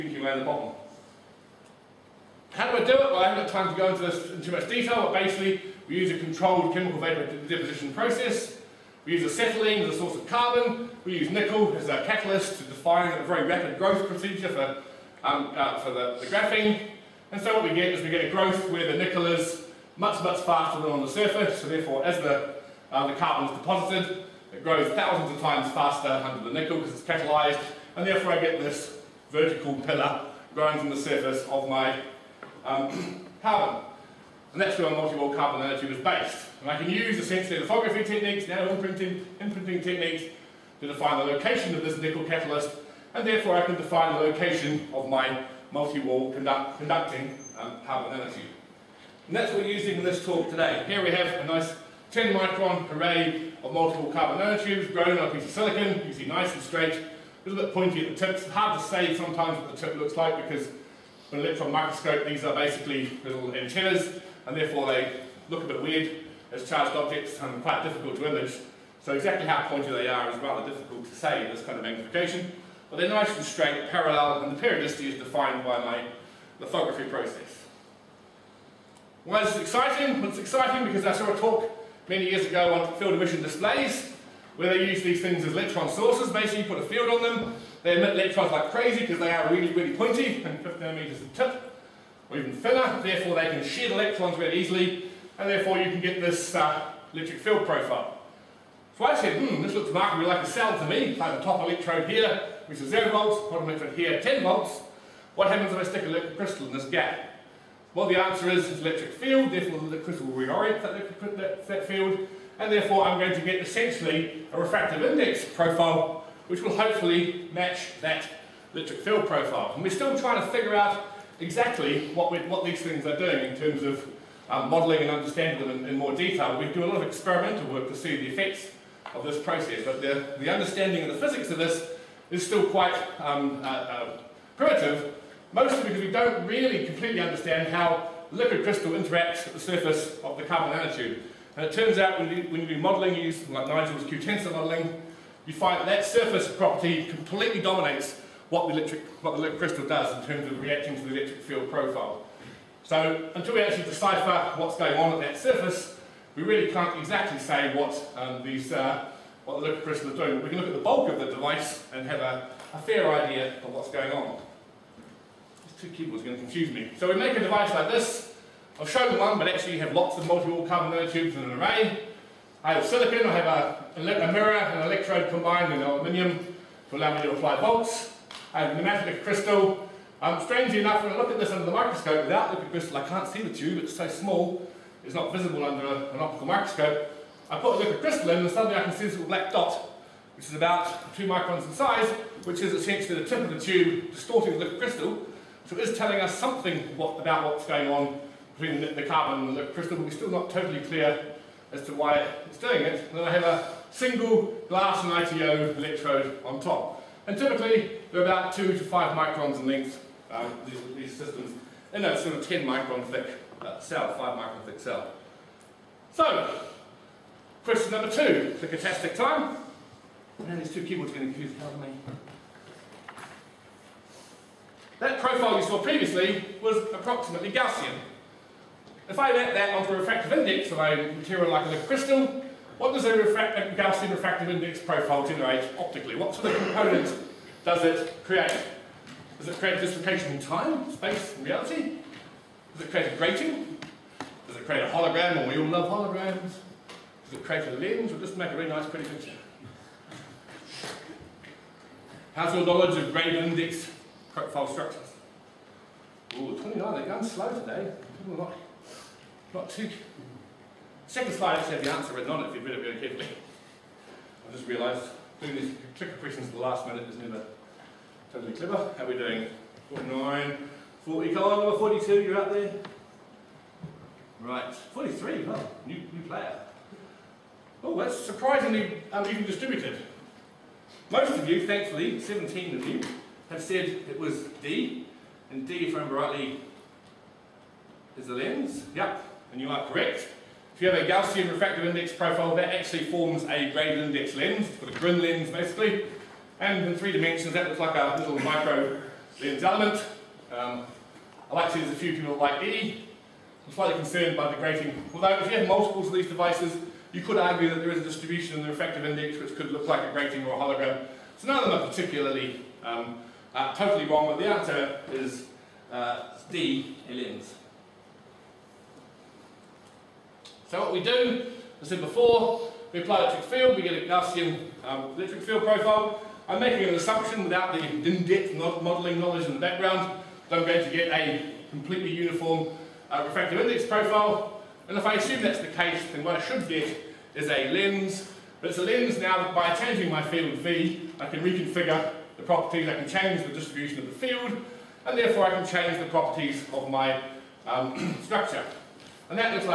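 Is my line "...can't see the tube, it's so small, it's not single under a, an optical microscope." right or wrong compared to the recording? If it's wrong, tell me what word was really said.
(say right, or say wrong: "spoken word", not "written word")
wrong: "visible", not "single".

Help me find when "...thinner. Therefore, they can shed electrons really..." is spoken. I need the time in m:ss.
1:32.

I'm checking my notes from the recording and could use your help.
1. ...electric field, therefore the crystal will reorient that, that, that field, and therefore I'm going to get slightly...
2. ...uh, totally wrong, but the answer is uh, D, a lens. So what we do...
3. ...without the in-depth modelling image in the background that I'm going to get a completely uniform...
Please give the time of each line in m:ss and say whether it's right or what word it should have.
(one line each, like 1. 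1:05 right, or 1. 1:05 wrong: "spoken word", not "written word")
1. 1:48 wrong: "essentially", not "slightly"
2. 5:13 right
3. 5:27 wrong: "knowledge", not "image".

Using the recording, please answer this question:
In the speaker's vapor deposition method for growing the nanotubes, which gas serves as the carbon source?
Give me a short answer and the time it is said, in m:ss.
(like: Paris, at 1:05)
acetylene, at 0:09.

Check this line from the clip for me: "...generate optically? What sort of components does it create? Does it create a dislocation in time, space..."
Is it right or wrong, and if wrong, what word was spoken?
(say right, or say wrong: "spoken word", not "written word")
right.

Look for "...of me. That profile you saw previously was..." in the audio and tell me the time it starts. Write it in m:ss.
3:41.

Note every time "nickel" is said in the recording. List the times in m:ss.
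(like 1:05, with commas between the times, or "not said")
0:11, 0:18, 0:26, 0:41.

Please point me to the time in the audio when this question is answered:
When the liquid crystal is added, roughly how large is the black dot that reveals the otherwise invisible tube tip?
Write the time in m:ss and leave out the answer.
3:11.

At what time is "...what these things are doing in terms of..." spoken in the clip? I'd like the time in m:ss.
2:02.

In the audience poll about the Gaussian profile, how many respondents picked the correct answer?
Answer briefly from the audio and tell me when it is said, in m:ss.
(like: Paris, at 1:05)
17, at 4:42.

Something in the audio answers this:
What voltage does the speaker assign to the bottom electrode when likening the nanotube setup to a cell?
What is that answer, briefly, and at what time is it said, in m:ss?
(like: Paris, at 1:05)
10 volts, at 1:44.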